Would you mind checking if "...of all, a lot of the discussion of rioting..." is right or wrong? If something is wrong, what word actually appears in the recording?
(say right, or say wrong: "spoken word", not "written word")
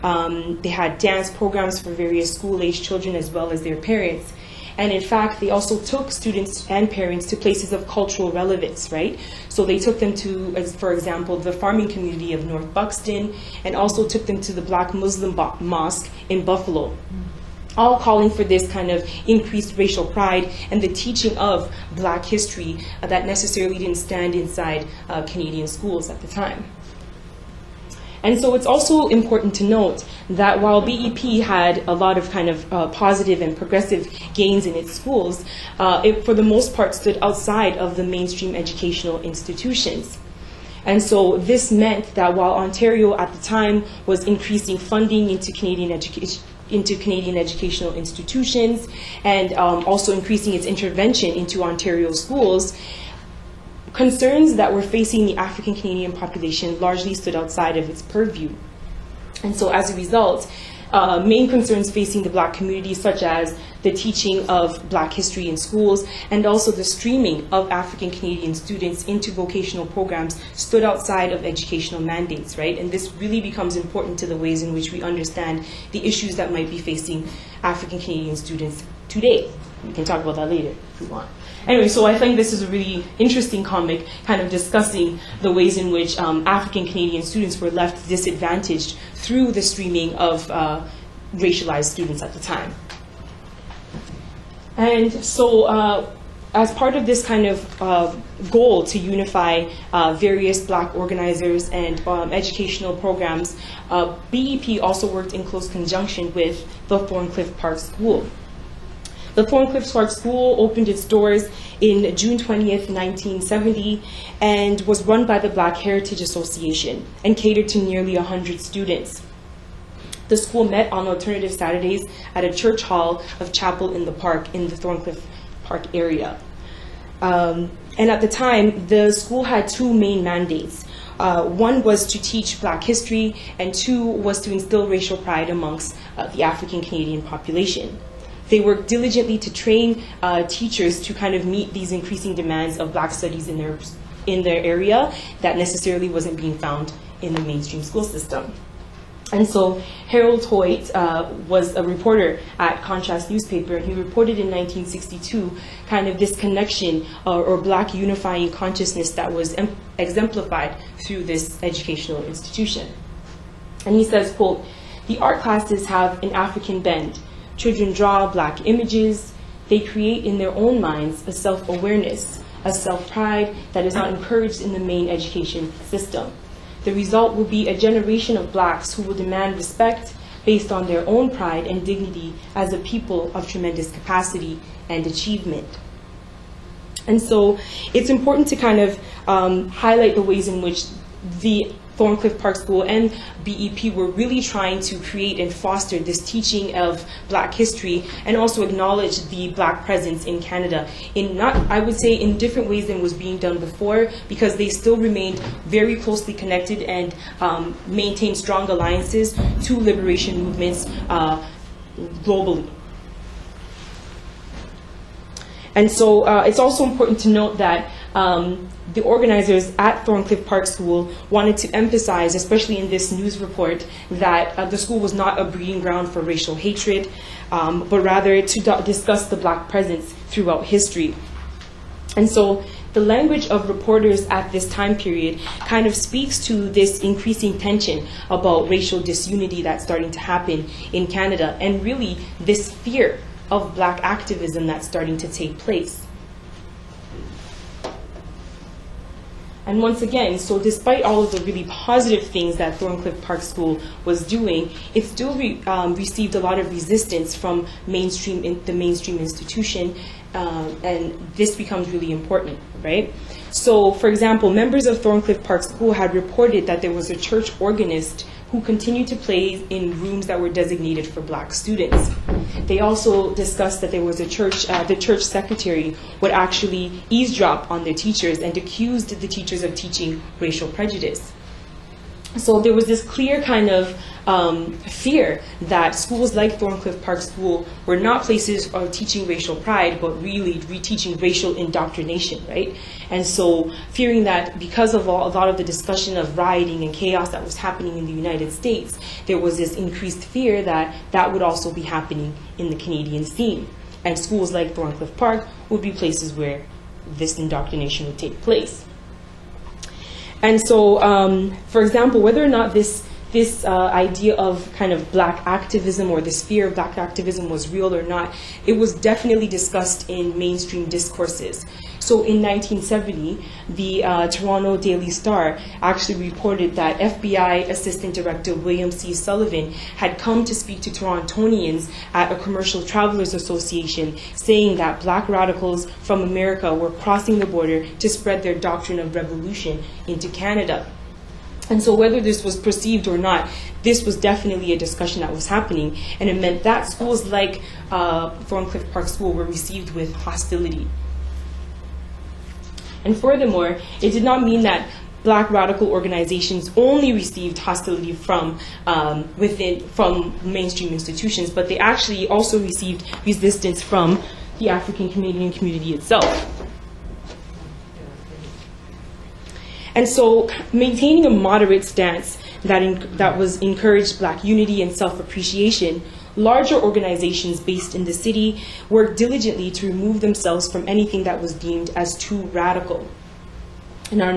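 right.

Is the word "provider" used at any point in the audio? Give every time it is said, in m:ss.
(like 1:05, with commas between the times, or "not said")
not said.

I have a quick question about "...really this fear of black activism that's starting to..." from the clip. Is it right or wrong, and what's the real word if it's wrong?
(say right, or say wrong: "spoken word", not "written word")
right.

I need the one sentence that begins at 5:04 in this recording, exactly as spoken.
And schools like Thorncliffe Park would be places where this indoctrination would take place.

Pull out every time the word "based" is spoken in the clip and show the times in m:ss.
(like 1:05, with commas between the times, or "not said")
3:00, 6:17.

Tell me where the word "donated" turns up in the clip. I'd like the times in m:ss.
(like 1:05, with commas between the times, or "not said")
not said.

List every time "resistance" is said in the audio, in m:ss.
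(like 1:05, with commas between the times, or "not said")
4:16, 6:03.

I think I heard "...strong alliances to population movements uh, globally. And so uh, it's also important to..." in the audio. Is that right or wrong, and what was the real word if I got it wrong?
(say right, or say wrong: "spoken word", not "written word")
wrong: "liberation", not "population".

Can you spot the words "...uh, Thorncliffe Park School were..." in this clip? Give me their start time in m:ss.
5:47.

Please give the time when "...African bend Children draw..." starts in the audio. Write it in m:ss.
2:46.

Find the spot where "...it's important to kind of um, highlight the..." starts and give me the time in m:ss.
3:07.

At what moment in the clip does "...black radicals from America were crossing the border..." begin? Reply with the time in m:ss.
5:35.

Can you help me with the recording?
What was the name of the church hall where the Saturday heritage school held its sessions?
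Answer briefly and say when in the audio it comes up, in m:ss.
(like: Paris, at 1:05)
Chapel in the Park, at 2:03.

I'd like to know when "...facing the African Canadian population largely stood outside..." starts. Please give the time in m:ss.
0:54.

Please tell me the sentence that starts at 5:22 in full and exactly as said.
So in 1970, the uh, Toronto Daily Star actually reported that FBI Assistant Director William C.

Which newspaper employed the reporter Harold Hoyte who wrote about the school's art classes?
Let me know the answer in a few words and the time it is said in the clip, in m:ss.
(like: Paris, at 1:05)
Contrast, at 2:32.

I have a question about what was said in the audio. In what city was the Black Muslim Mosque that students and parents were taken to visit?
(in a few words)
Buffalo.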